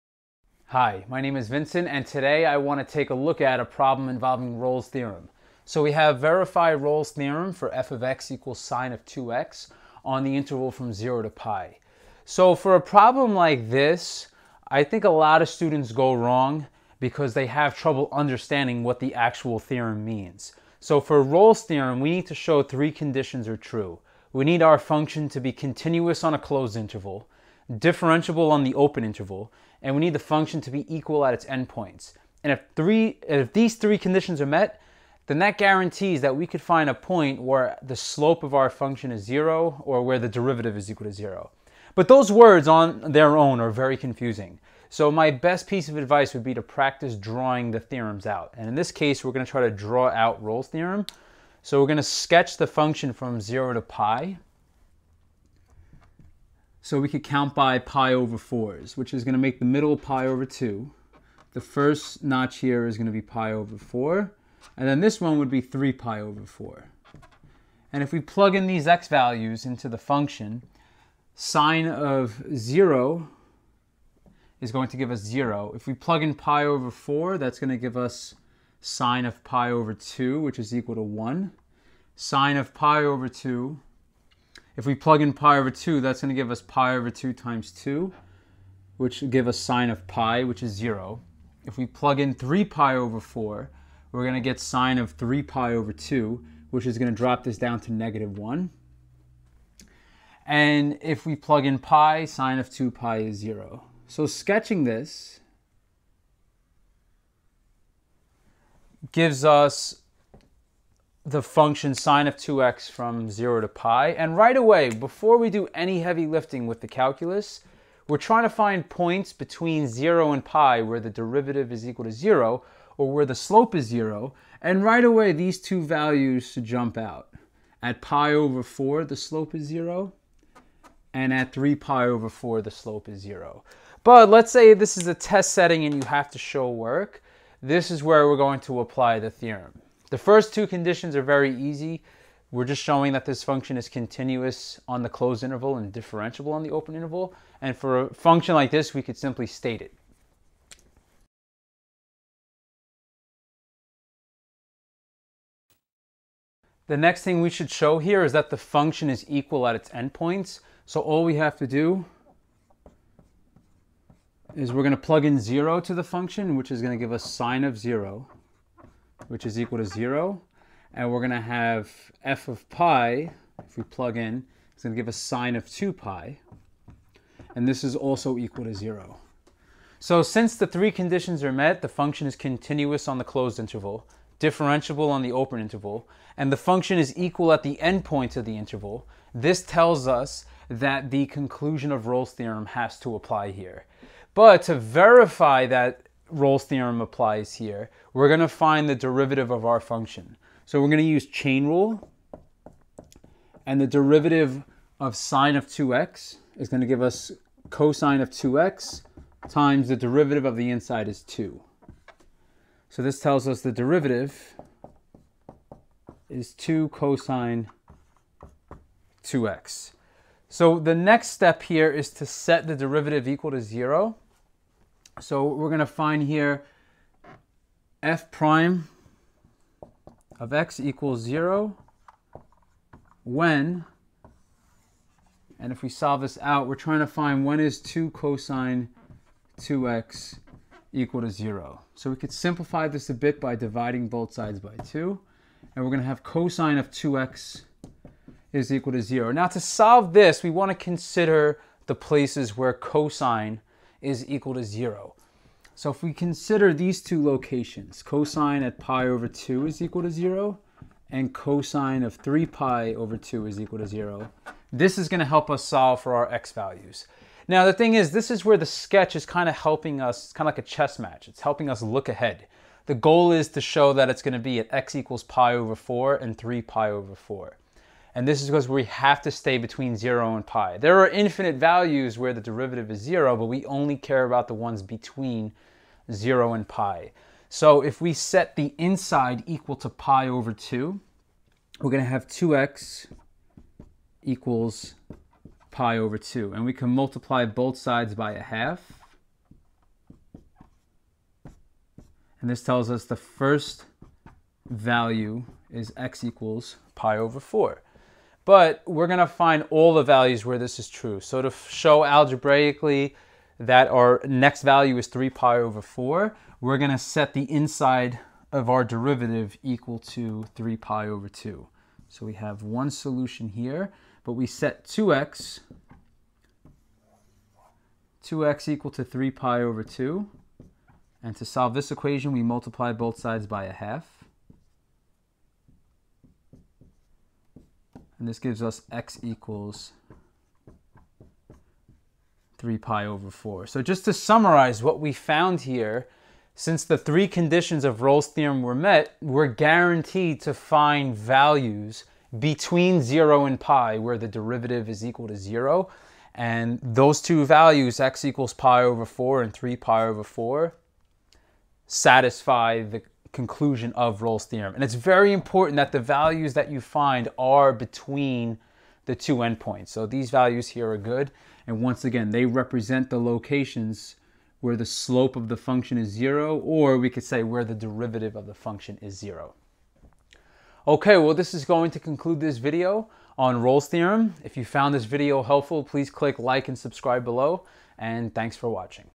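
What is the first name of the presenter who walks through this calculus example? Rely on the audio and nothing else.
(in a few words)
Vincent.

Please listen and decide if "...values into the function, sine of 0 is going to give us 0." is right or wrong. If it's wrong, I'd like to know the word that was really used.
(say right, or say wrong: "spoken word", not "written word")
right.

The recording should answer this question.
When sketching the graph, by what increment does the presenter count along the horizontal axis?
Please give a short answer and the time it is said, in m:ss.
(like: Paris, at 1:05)
pi over 4, at 0:57.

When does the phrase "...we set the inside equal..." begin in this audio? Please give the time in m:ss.
4:48.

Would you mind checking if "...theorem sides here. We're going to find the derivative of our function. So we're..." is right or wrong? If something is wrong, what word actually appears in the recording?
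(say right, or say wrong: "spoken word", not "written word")
wrong: "applies", not "sides".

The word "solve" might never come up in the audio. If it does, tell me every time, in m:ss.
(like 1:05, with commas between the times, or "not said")
3:55, 4:09, 4:25, 5:31.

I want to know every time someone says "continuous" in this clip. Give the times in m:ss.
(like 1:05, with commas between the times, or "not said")
0:25, 2:23, 3:02.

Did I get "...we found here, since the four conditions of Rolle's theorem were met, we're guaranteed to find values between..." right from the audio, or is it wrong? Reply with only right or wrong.
wrong.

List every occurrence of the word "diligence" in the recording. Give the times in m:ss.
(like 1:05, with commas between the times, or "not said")
not said.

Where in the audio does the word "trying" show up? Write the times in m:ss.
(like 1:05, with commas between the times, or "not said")
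1:58, 3:56.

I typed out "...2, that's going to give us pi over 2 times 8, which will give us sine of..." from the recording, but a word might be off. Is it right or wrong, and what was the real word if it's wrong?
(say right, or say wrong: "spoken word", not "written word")
wrong: "2", not "8".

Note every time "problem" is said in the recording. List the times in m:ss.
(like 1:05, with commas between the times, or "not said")
0:03, 0:12.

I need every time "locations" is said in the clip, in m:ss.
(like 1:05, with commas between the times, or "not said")
4:17, 6:13.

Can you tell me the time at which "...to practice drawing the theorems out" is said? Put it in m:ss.
0:46.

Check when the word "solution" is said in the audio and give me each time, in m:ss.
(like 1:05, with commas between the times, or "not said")
5:22.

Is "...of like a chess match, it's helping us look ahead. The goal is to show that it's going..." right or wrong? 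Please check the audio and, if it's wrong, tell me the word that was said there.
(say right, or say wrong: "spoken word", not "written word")
right.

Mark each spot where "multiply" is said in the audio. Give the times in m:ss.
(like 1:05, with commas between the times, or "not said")
4:56, 5:32.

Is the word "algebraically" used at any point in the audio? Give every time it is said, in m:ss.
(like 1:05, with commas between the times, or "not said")
5:12.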